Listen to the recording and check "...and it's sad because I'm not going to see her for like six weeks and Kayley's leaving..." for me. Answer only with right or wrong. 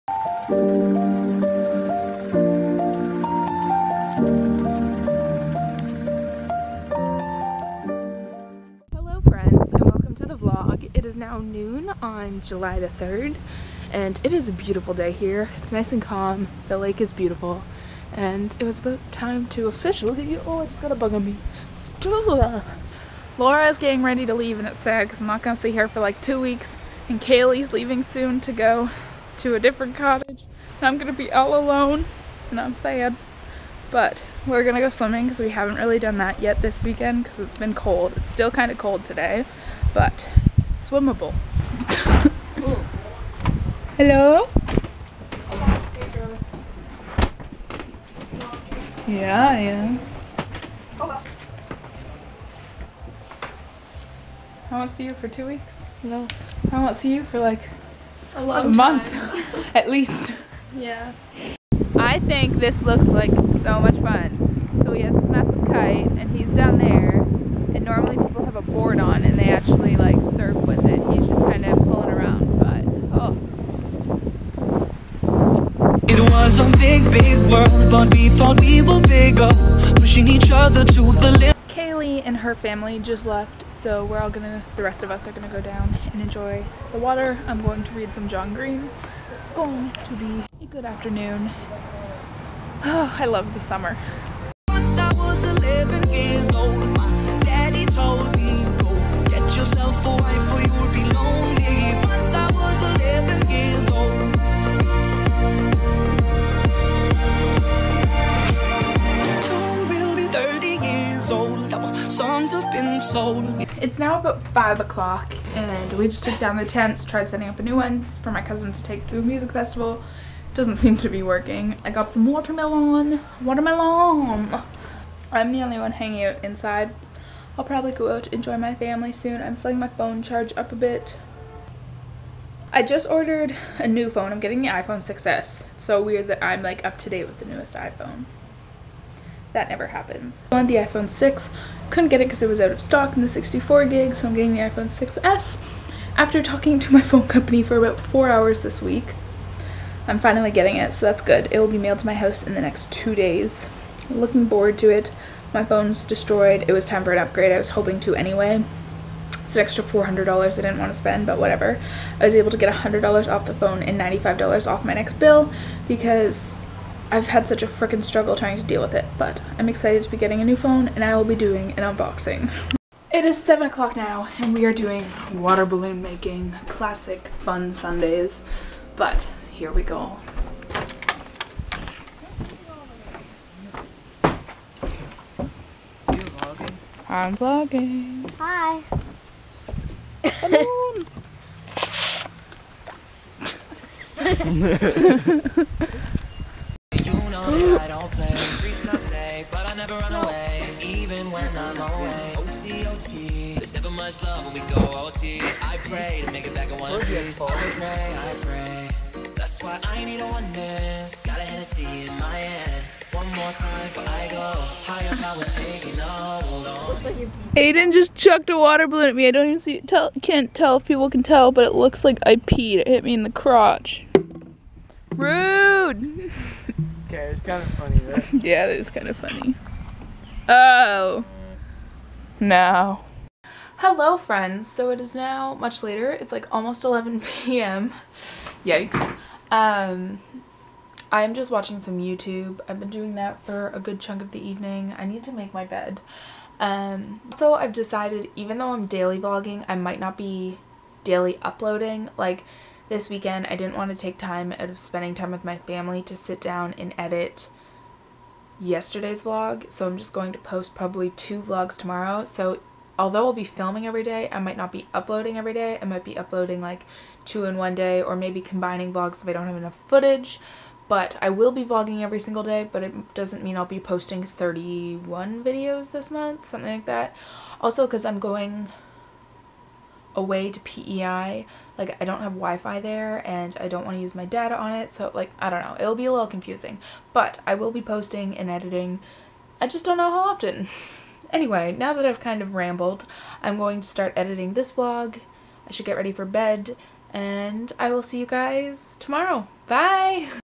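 wrong.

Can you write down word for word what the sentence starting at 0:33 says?
But we're gonna go swimming because we haven't really done that yet this weekend because it's been cold.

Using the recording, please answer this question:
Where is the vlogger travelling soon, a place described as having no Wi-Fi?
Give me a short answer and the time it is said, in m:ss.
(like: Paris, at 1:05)
PEI, at 4:40.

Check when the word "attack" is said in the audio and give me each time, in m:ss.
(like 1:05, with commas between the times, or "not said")
not said.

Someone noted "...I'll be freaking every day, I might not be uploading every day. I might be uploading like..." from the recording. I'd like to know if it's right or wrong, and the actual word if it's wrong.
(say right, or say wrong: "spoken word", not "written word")
wrong: "filming", not "freaking".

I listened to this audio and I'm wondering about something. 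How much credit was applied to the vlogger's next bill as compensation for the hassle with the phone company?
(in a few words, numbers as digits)
$95.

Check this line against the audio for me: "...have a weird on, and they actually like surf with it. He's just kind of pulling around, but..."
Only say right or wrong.
wrong.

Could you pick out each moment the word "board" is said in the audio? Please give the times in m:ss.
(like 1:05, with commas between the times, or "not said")
1:08.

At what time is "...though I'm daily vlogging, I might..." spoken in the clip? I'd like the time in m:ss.
4:08.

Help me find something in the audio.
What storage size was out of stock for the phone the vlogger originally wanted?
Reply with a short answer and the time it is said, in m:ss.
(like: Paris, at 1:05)
64 gig, at 2:23.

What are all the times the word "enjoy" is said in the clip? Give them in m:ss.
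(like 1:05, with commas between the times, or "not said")
1:26, 2:08.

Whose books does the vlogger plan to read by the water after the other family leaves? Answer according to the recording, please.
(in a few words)
John Green.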